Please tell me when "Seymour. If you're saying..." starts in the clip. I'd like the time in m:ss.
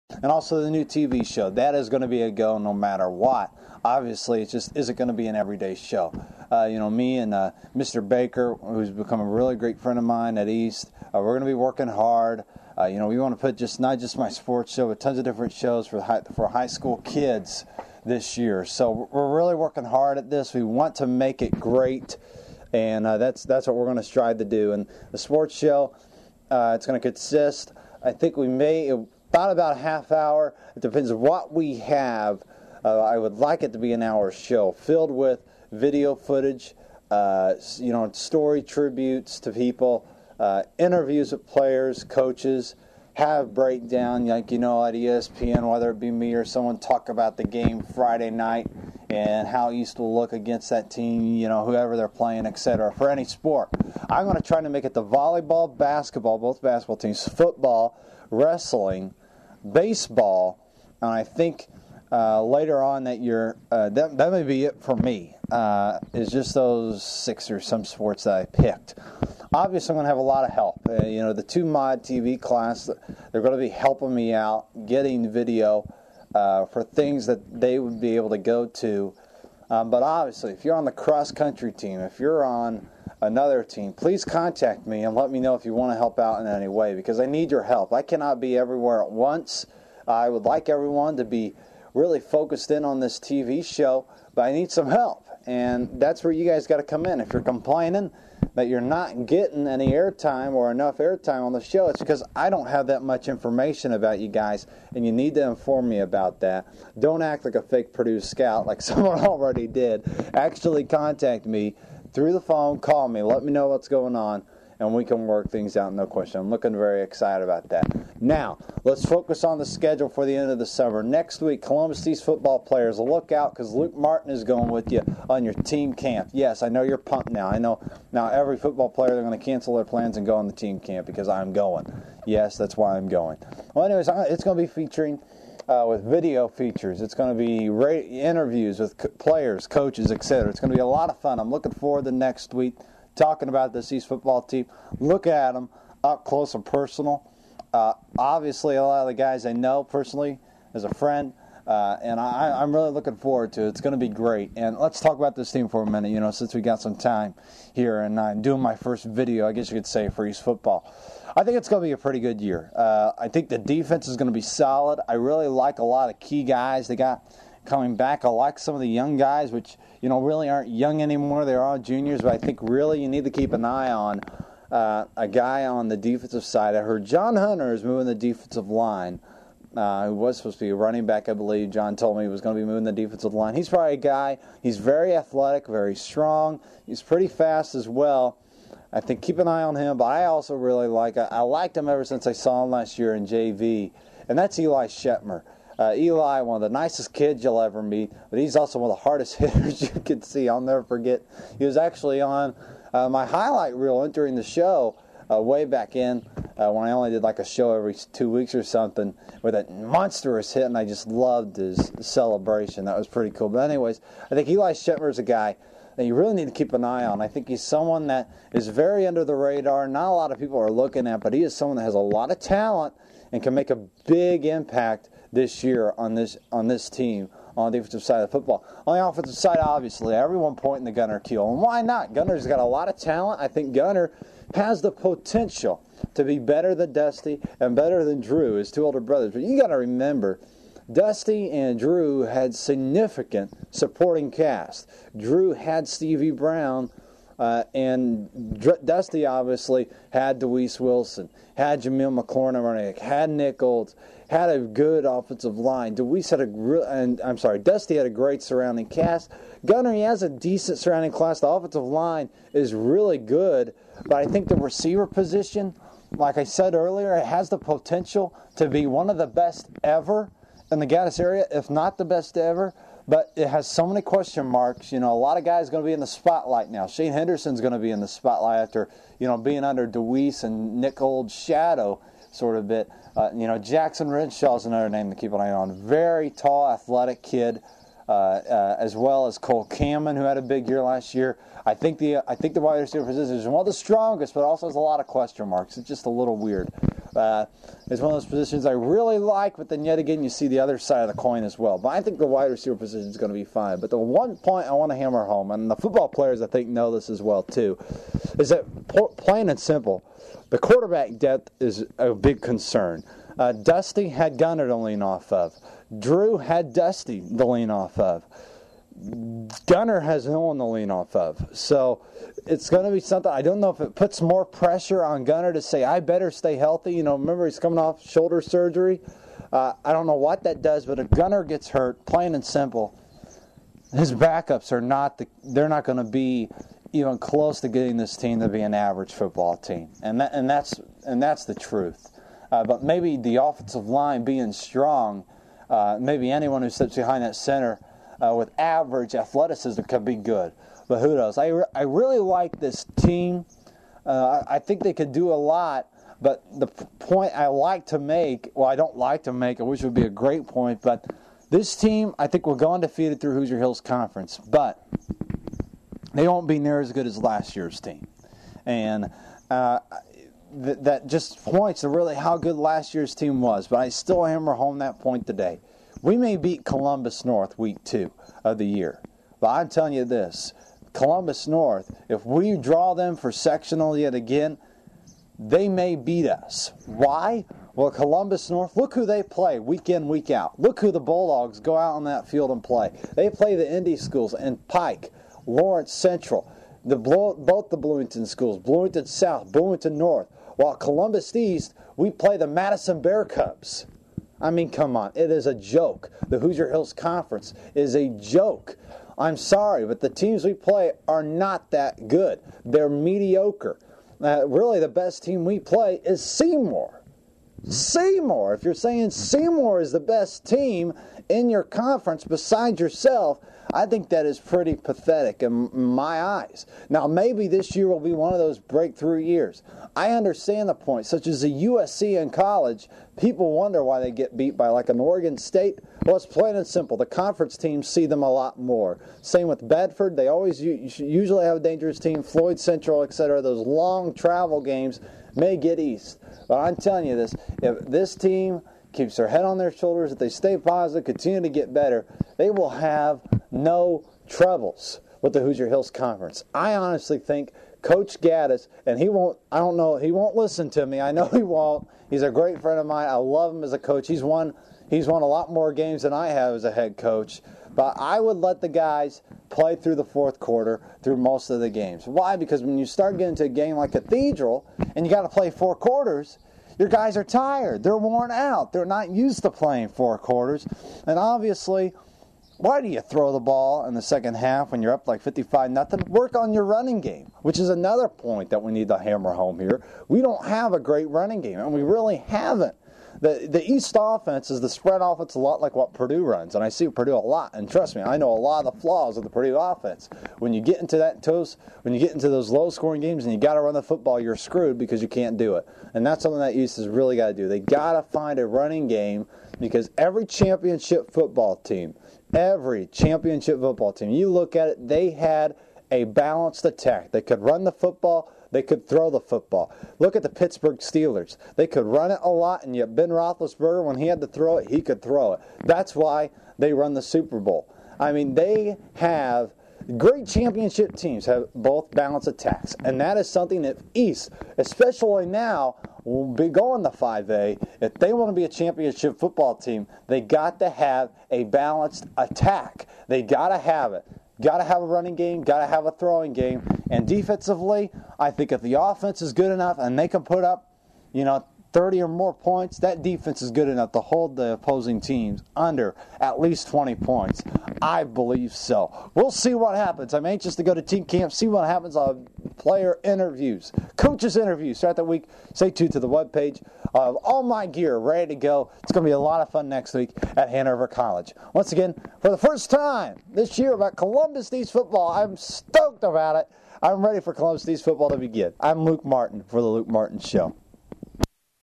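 6:57.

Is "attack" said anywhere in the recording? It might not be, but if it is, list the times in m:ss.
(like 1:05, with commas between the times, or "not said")
8:36, 8:52, 9:02.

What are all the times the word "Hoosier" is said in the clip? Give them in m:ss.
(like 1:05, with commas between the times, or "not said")
6:03, 6:46, 7:35.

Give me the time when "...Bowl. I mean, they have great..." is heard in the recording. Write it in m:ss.
8:47.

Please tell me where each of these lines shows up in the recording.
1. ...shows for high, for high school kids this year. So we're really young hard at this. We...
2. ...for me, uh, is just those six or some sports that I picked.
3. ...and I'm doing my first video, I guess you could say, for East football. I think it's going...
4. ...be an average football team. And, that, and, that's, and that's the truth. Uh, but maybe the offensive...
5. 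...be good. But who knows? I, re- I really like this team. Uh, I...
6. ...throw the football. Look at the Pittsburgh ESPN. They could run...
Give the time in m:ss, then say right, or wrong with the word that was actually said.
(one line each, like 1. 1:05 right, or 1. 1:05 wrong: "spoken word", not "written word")
1. 0:15 wrong: "working", not "young"
2. 1:04 right
3. 2:38 right
4. 5:38 right
5. 5:50 right
6. 8:38 wrong: "Steelers", not "ESPN".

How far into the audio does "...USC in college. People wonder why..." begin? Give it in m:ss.
7:11.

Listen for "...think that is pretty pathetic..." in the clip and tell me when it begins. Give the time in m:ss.
7:03.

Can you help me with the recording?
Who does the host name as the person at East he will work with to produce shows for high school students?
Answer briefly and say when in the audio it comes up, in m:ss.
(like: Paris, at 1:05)
Mr. 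Baker, at 0:07.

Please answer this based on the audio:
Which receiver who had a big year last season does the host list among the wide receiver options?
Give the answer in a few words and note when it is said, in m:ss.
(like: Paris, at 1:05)
Cole Cameron, at 4:49.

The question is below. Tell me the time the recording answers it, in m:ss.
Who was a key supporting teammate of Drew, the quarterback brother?
4:05.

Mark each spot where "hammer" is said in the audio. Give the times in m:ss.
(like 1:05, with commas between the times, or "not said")
5:04, 6:14, 8:08.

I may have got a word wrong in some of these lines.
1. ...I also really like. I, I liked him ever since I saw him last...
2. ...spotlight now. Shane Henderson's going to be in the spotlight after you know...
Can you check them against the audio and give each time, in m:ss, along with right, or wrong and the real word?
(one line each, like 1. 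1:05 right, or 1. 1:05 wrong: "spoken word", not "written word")
1. 3:10 right
2. 4:36 right.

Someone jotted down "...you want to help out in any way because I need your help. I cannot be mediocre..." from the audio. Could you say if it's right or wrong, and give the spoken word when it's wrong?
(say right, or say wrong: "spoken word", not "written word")
wrong: "everywhere", not "mediocre".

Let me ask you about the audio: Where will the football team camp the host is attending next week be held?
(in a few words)
Hanover College.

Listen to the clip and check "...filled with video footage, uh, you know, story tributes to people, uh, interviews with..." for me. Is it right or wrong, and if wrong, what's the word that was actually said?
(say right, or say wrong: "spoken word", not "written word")
right.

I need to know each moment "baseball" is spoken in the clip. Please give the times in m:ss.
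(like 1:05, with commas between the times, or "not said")
0:59.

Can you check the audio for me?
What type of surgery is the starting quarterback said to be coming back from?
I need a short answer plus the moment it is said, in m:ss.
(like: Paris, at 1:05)
shoulder surgery, at 5:28.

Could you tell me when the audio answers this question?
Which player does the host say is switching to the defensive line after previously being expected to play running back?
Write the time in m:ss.
2:57.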